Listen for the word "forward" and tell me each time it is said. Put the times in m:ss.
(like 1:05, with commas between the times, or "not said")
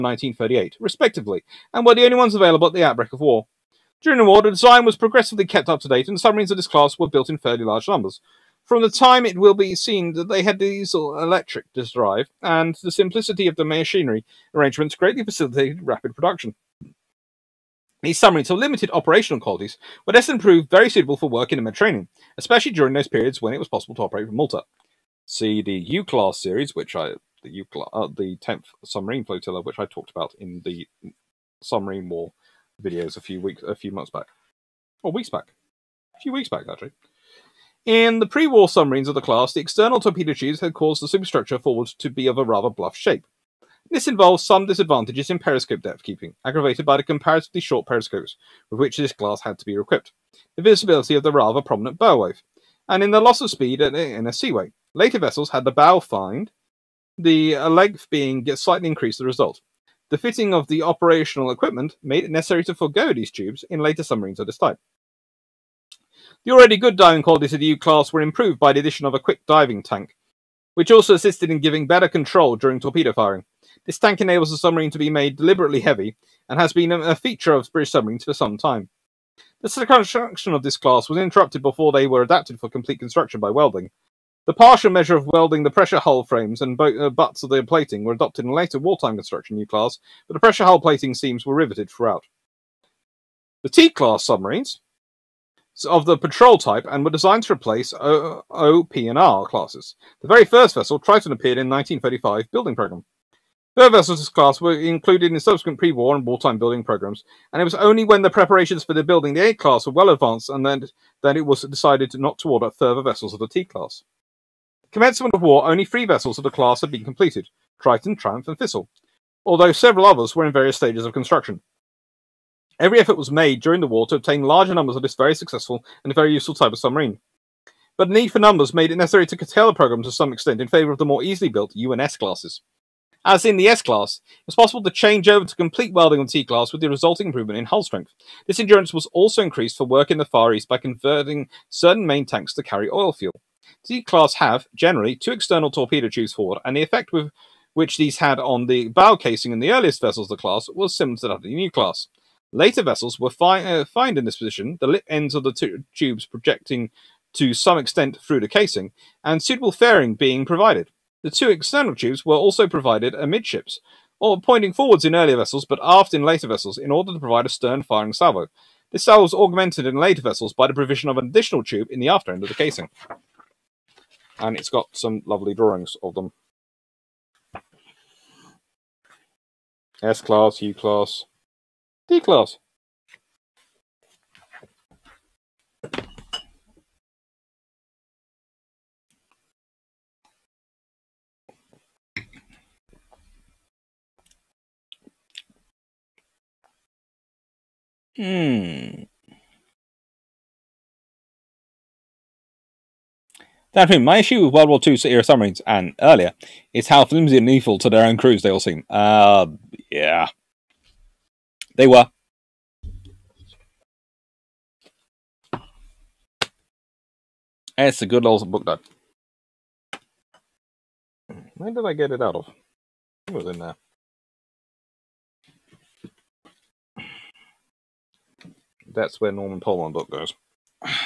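0:41, 2:26, 2:44.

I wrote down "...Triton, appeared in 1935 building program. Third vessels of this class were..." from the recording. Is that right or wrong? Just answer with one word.
right.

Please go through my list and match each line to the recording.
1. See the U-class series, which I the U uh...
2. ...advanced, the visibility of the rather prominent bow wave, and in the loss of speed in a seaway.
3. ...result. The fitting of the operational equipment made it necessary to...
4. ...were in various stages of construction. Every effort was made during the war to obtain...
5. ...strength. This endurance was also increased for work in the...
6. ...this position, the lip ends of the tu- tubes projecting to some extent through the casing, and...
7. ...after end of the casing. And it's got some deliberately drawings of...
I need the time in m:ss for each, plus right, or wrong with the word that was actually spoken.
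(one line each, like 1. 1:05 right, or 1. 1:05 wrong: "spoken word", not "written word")
1. 0:25 right
2. 0:49 wrong: "equipped", not "advanced"
3. 0:59 right
4. 2:00 right
5. 2:17 right
6. 2:34 right
7. 2:52 wrong: "lovely", not "deliberately".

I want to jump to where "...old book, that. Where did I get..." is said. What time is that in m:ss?
3:38.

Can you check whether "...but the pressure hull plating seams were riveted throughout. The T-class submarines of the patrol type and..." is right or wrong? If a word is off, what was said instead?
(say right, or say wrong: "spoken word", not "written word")
right.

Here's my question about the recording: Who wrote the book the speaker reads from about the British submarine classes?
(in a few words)
Norman Polmar.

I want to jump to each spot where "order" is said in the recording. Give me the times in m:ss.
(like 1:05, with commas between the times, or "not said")
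1:52, 2:46.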